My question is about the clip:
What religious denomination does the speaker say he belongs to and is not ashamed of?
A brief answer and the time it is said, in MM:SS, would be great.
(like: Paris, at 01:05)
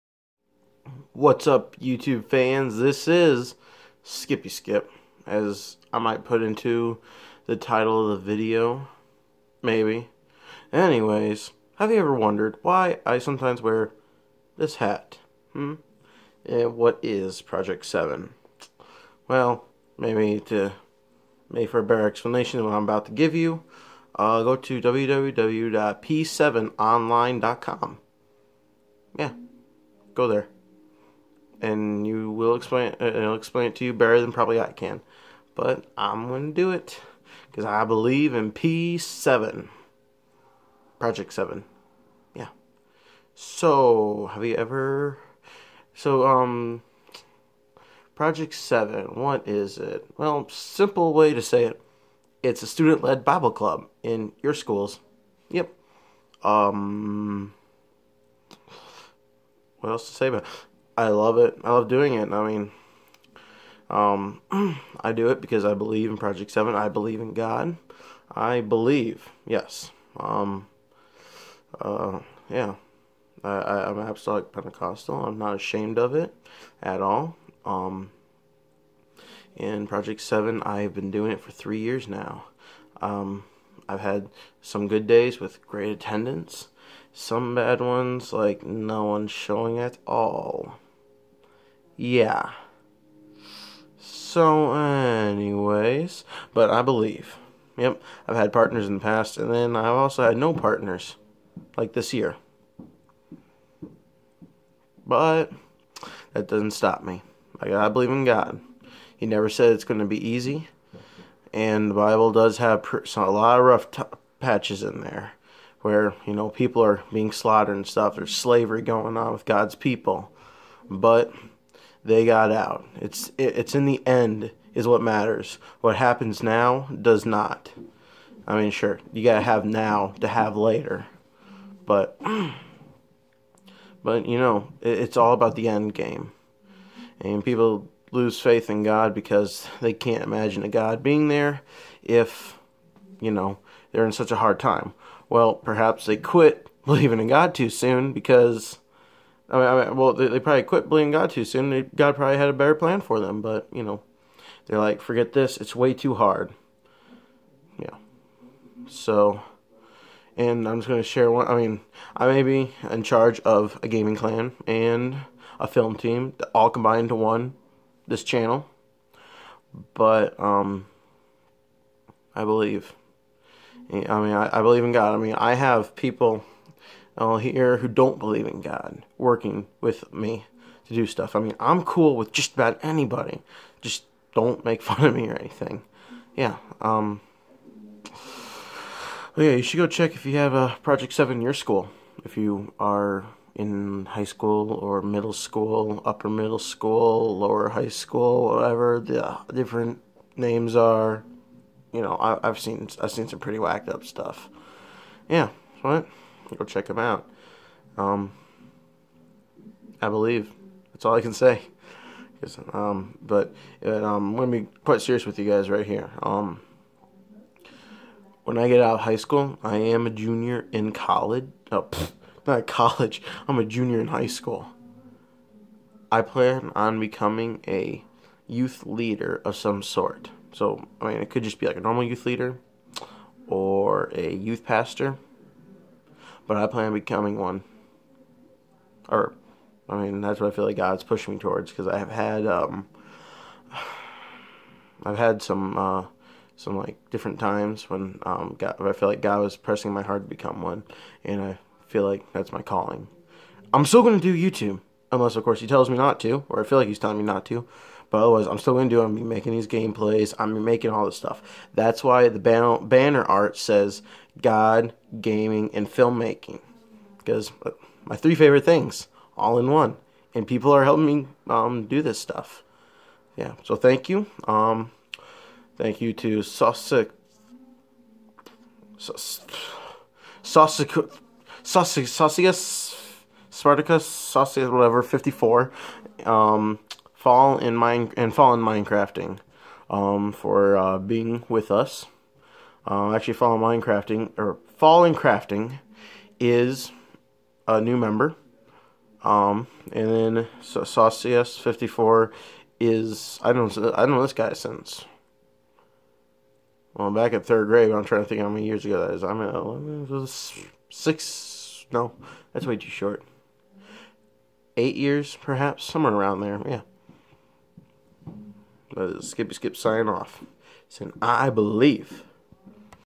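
Apostolic Pentecostal, at 01:13.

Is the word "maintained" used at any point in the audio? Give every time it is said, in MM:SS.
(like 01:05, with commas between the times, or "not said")
not said.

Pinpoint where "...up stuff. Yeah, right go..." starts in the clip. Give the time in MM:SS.
03:23.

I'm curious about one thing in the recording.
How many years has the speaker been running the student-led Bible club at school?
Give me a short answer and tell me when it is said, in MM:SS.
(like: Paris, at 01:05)
3 years, at 01:21.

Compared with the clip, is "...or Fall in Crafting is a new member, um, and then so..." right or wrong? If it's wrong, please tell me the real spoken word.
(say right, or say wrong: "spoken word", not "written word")
right.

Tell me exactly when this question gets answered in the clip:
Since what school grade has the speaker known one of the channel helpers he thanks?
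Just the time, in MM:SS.
05:07.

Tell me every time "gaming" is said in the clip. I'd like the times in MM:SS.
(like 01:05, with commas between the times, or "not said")
02:43, 04:25.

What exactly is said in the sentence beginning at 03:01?
I mean, I'm cool with just about anybody.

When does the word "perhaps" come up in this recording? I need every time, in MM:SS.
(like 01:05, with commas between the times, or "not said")
02:25, 05:15.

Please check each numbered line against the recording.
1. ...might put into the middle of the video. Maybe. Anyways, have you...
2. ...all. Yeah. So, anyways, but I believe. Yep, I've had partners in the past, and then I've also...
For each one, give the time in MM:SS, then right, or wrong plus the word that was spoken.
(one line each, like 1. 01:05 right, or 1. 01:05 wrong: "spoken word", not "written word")
1. 00:05 wrong: "title", not "middle"
2. 01:30 right.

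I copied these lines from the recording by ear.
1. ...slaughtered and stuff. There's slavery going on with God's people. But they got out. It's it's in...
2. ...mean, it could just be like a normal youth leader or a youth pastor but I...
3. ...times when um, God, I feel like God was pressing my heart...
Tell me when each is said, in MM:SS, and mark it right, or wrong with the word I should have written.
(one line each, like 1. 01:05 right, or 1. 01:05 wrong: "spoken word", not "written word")
1. 01:57 right
2. 03:51 right
3. 04:07 right.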